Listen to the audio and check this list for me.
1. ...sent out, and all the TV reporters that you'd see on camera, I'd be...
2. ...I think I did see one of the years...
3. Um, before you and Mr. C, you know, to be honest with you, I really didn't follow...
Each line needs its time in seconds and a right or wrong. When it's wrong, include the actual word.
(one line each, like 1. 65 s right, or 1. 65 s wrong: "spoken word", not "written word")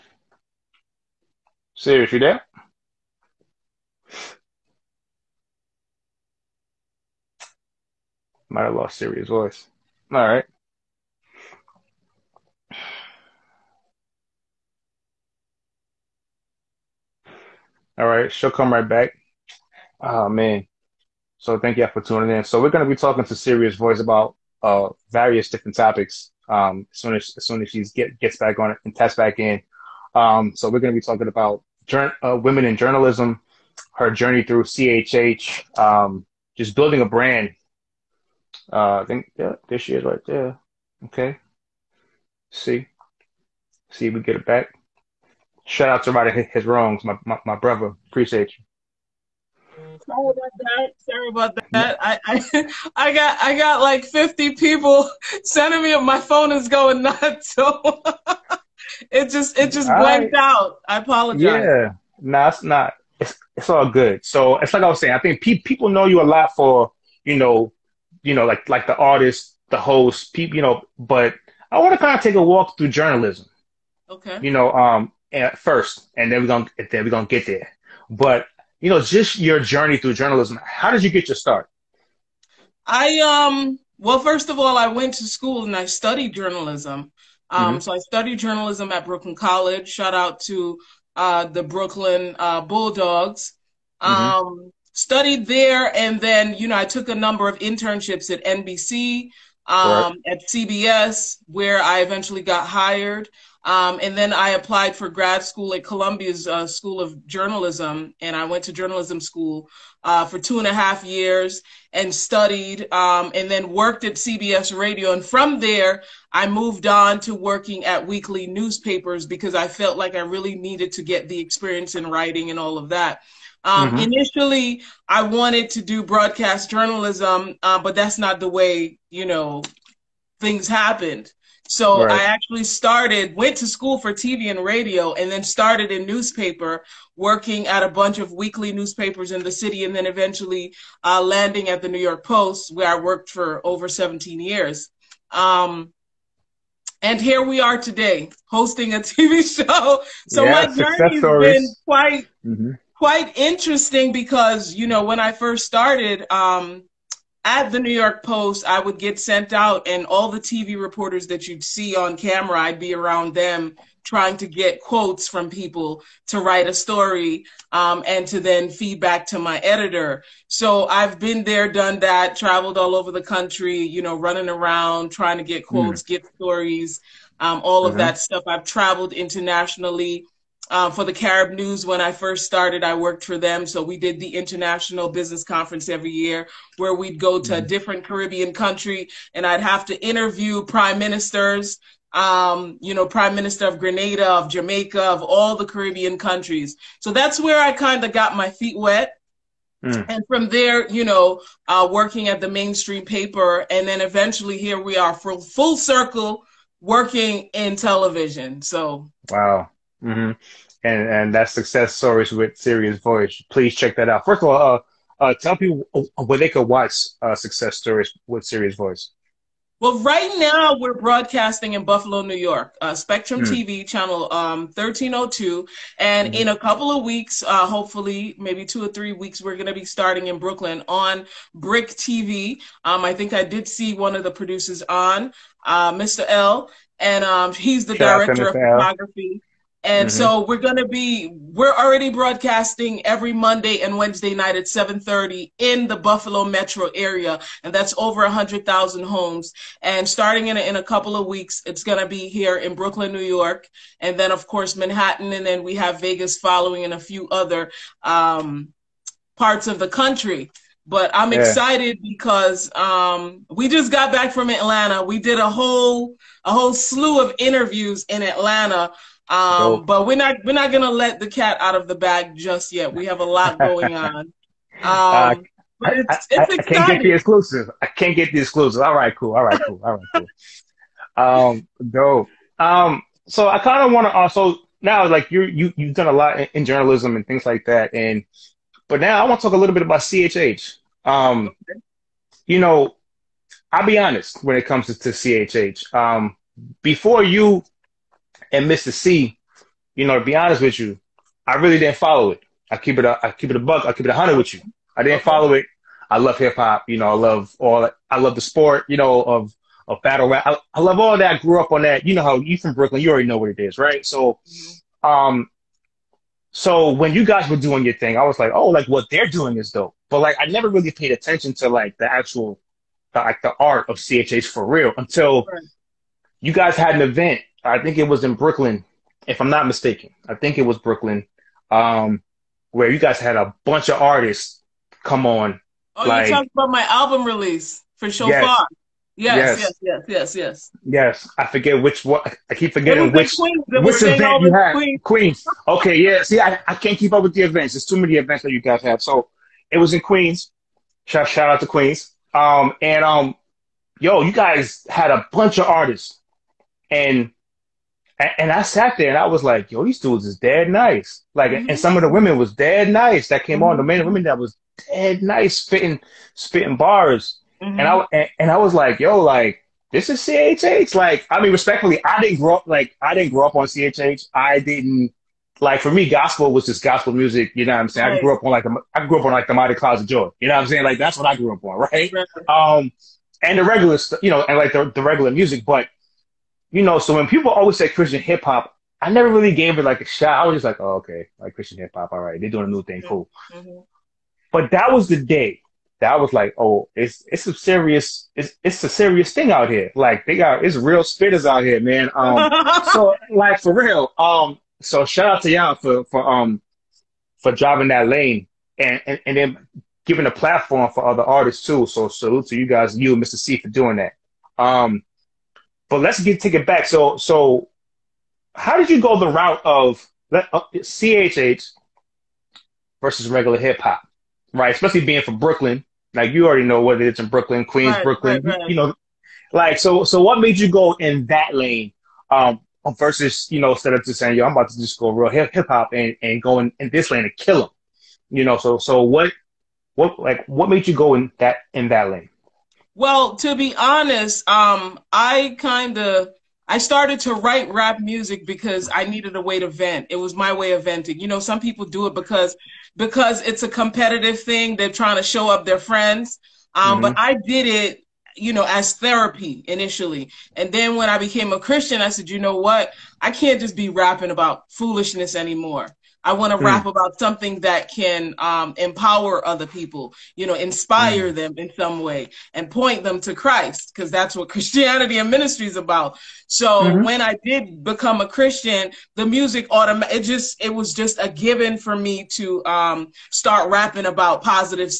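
1. 159 s right
2. 233 s wrong: "producers", not "years"
3. 295 s right.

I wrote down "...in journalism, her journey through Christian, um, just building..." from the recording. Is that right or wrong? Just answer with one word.
wrong.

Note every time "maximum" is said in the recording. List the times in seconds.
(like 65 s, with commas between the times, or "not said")
not said.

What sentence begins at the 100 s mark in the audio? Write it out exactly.
at CBS, where I eventually got hired.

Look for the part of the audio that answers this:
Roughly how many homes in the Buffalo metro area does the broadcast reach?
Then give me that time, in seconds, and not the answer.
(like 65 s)
247 s.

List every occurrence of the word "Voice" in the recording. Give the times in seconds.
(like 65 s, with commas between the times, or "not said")
9 s, 23 s, 212 s, 218 s.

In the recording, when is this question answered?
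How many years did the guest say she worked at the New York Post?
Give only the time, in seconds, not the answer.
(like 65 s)
143 s.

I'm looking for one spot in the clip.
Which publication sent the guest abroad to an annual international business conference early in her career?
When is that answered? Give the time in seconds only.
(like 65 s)
181 s.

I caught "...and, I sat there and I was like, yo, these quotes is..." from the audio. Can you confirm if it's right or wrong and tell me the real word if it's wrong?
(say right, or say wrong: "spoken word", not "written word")
wrong: "dudes", not "quotes".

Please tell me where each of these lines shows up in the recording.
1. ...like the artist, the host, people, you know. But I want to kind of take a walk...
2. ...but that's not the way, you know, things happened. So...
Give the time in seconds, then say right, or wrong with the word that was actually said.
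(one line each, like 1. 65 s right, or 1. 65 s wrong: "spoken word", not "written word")
1. 68 s right
2. 127 s right.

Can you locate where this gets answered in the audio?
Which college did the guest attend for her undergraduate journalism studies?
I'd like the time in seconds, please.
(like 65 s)
89 s.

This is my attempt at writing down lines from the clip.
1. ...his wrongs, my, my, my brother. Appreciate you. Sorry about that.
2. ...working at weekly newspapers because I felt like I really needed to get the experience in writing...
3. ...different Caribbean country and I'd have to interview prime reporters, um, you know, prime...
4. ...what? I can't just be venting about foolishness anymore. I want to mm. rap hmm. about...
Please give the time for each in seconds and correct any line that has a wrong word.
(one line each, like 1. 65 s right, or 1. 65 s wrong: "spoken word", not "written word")
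1. 46 s right
2. 117 s right
3. 187 s wrong: "ministers", not "reporters"
4. 462 s wrong: "rapping", not "venting".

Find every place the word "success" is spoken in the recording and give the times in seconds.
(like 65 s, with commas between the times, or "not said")
211 s, 217 s.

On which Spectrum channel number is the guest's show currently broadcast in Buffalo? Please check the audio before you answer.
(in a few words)
1302.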